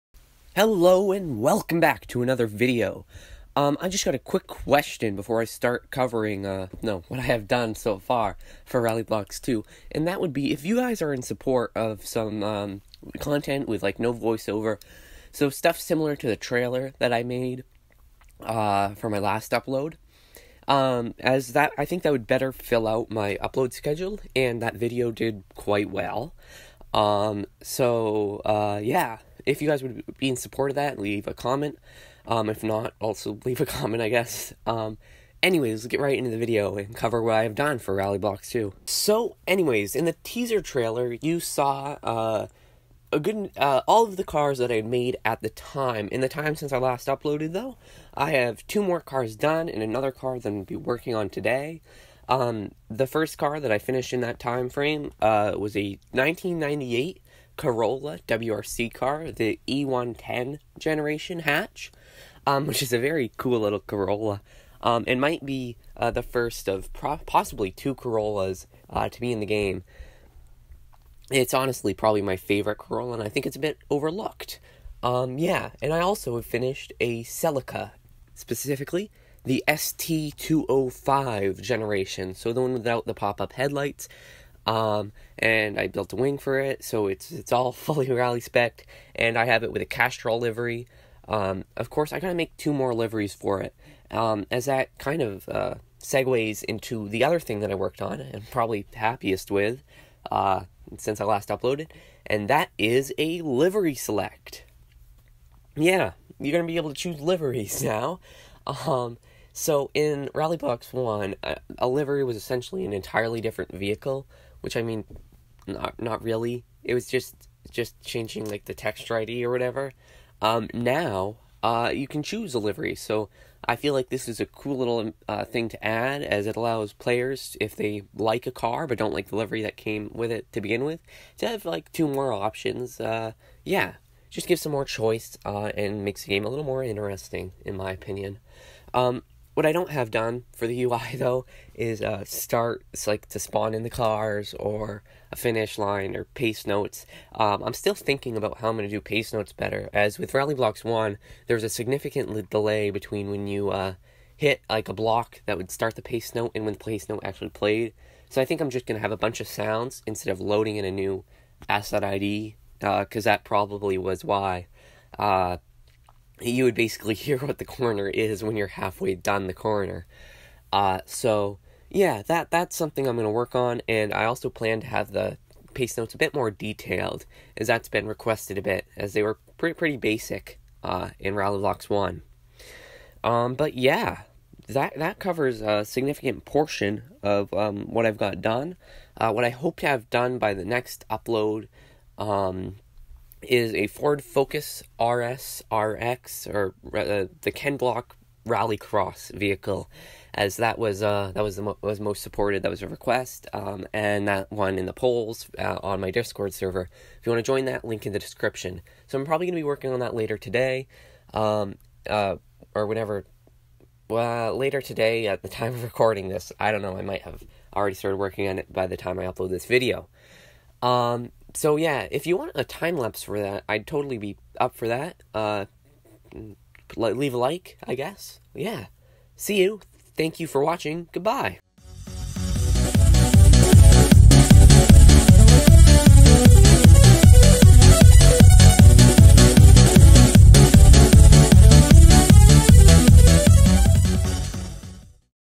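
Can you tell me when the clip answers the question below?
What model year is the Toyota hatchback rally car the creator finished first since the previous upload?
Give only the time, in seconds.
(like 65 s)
56 s.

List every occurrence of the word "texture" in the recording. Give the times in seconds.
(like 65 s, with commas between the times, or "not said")
118 s.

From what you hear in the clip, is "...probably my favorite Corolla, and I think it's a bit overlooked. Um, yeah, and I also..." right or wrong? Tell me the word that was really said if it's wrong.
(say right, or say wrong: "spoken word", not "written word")
right.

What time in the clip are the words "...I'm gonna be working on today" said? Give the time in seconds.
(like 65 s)
50 s.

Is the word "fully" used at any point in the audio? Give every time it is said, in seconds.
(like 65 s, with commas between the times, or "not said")
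87 s.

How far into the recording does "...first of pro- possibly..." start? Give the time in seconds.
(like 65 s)
66 s.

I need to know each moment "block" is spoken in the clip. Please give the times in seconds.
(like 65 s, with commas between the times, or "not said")
154 s, 197 s.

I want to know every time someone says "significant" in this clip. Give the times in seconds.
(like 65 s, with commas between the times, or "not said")
151 s, 185 s.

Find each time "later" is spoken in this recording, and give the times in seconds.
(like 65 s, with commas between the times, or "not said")
210 s, 214 s.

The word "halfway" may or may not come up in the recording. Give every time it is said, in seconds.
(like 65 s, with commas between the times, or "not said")
168 s.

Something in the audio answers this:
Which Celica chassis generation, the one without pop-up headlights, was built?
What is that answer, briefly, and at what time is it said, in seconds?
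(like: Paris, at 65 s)
ST205, at 79 s.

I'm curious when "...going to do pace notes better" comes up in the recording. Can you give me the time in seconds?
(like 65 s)
148 s.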